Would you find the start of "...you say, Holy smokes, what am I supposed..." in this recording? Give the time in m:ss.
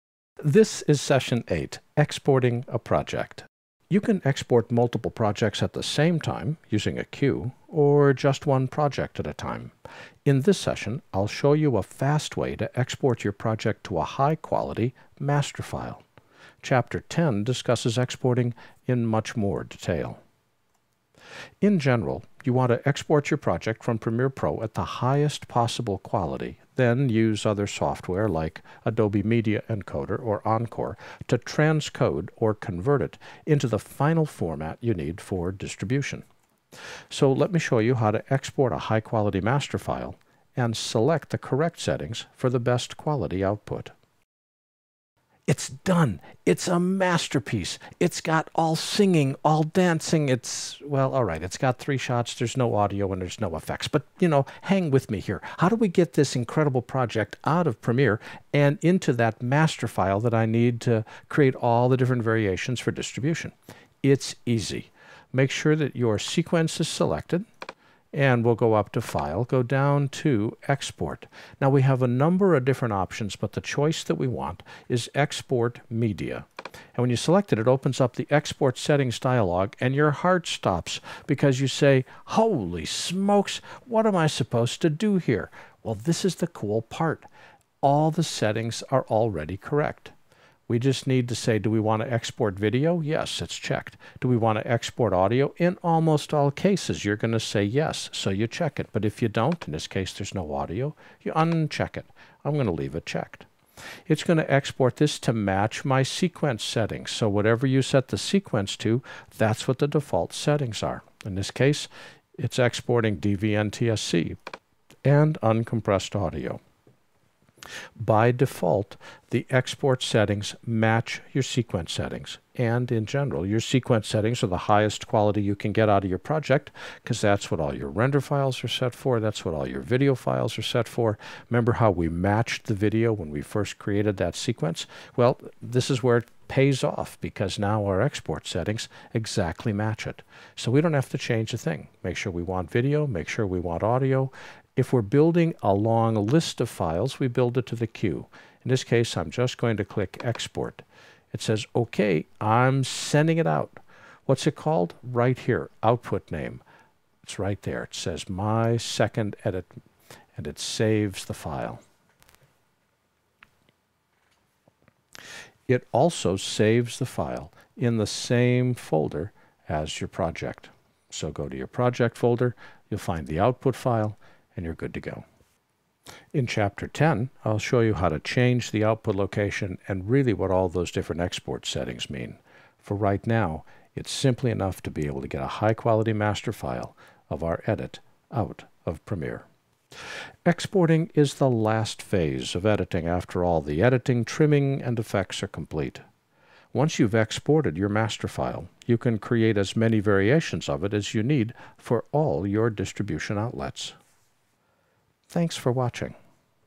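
1:21.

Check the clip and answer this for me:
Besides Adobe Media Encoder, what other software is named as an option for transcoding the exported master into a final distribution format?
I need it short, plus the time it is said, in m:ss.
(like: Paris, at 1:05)
Encore, at 0:30.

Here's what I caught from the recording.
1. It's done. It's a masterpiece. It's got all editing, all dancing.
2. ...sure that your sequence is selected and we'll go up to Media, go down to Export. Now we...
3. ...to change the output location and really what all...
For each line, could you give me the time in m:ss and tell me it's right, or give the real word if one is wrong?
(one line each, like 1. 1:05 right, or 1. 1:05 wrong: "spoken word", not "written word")
1. 0:45 wrong: "singing", not "editing"
2. 1:05 wrong: "File", not "Media"
3. 2:58 right.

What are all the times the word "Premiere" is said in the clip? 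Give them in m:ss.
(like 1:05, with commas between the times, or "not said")
0:23, 0:57, 3:09.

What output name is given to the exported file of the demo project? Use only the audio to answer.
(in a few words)
My second edit.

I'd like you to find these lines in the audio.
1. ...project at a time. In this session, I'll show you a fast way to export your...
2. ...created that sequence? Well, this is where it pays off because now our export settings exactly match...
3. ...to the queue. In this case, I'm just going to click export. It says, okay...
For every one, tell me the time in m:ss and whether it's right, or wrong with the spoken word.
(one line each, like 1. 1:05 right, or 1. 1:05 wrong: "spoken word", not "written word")
1. 0:08 right
2. 2:13 right
3. 2:27 right.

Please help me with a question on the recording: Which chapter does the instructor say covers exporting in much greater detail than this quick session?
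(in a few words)
Chapter 10.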